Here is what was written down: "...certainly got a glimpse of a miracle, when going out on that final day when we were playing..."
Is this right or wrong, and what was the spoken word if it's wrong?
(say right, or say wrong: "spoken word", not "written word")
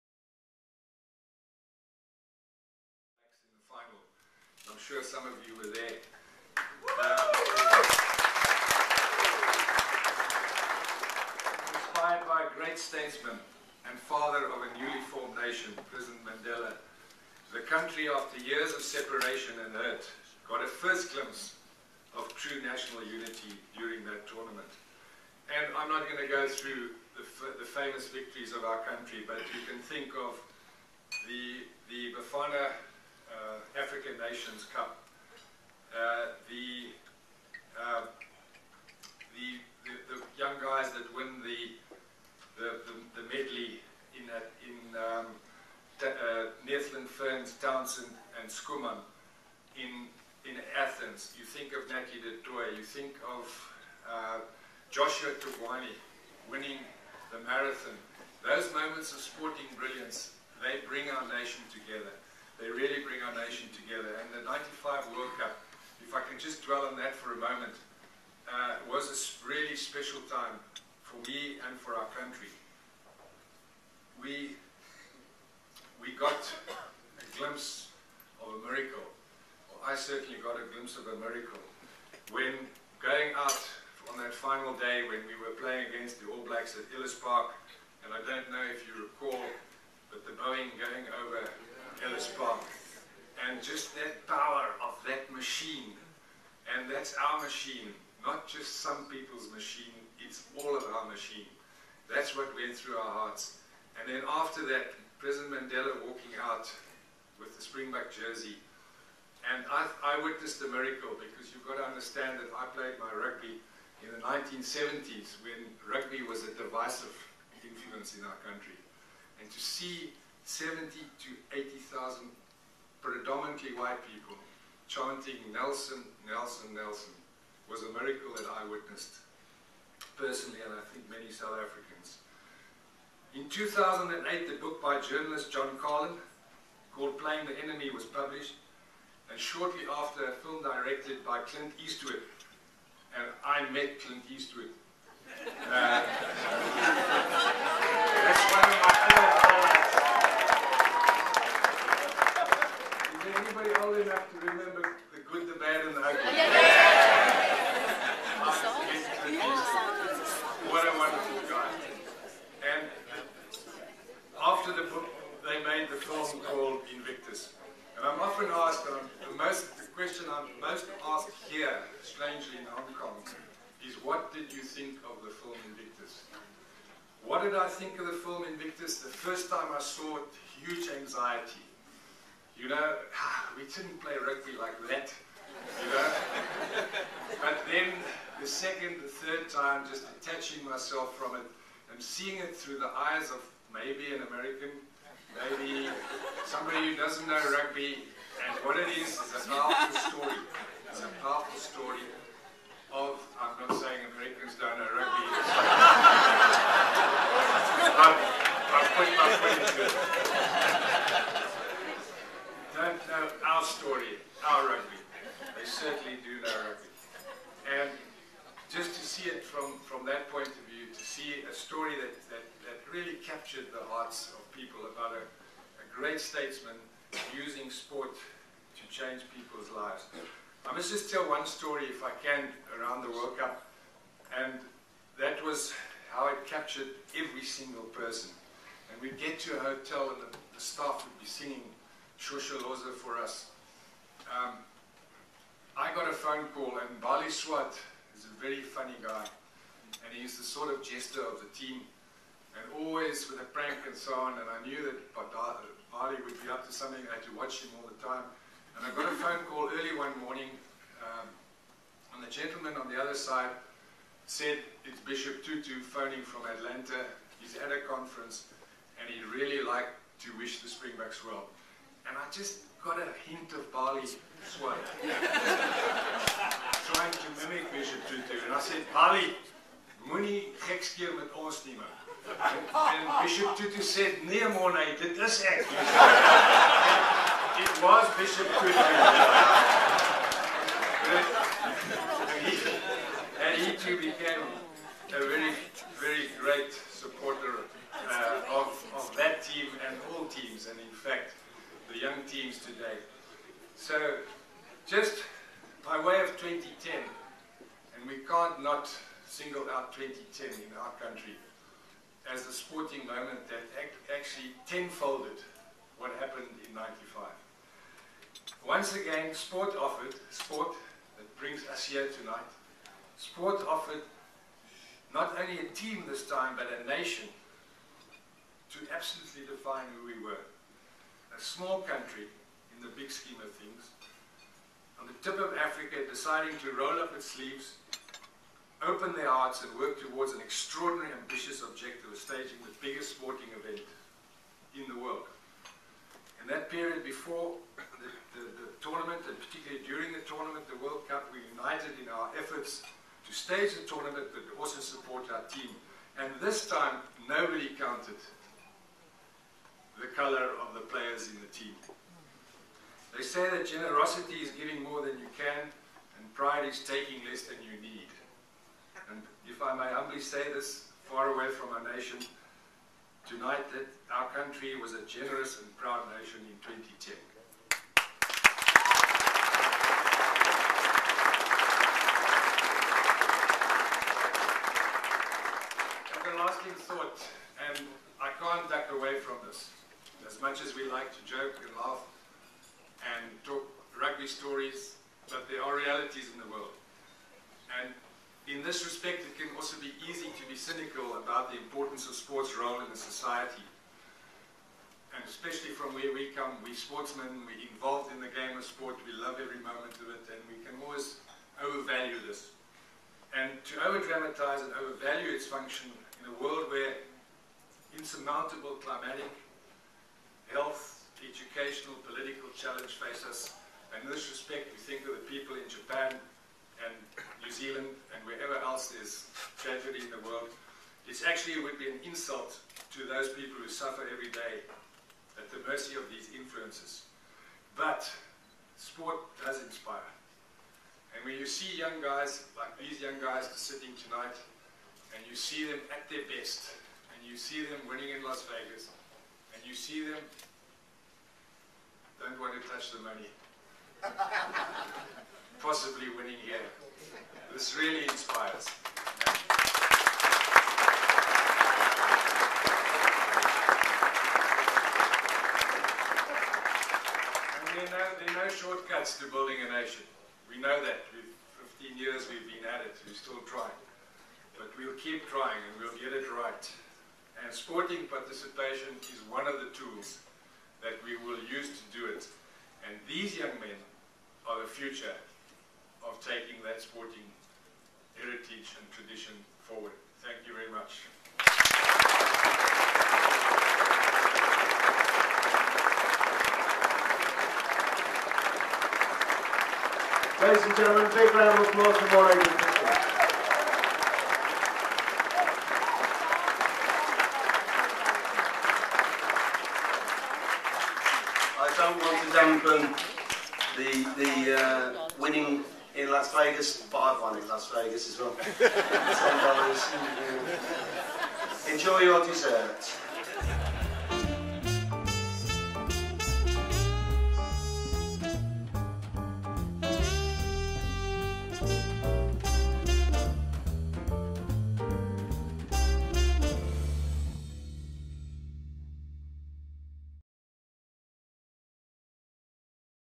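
right.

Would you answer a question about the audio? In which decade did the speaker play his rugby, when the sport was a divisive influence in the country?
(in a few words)
1970s.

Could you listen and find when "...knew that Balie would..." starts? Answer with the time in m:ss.
4:14.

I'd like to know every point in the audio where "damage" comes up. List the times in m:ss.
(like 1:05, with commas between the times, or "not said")
not said.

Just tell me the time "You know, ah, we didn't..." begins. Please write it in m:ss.
3:02.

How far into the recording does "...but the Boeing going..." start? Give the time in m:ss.
1:30.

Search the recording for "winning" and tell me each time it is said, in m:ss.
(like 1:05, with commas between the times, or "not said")
0:56, 7:27, 7:36, 8:35.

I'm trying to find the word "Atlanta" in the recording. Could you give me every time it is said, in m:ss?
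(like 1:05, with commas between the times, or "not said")
4:26.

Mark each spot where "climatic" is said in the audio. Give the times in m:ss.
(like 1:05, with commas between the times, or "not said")
6:58.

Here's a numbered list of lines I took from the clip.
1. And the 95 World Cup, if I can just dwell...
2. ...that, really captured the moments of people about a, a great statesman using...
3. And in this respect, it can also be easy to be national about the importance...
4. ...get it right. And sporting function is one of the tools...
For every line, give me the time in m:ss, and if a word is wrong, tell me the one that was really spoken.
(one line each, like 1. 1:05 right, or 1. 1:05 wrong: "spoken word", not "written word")
1. 1:04 right
2. 3:42 wrong: "hearts", not "moments"
3. 6:37 wrong: "cynical", not "national"
4. 7:55 wrong: "participation", not "function".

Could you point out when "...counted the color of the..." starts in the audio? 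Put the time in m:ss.
5:57.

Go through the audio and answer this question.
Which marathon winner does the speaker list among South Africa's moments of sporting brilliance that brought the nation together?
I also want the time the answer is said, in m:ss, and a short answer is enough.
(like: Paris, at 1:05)
Joshua Thugwane, at 0:54.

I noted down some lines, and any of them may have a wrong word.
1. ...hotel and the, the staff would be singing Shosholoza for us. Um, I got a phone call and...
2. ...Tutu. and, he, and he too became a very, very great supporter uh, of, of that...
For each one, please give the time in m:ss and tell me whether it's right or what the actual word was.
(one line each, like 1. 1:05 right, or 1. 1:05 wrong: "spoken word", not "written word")
1. 3:59 right
2. 4:48 right.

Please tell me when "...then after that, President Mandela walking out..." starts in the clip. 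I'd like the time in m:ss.
1:44.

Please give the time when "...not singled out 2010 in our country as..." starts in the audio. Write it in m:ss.
5:08.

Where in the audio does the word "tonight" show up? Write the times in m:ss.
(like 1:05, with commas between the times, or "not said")
5:22, 6:13, 7:24.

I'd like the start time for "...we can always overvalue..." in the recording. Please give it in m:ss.
6:50.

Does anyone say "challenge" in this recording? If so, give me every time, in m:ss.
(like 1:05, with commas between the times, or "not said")
7:02.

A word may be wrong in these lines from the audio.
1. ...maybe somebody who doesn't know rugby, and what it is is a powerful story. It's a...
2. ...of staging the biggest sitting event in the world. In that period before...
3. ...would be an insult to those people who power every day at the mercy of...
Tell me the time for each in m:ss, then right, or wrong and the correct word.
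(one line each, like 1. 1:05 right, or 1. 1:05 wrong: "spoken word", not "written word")
1. 3:15 right
2. 5:42 wrong: "sporting", not "sitting"
3. 7:11 wrong: "suffer", not "power".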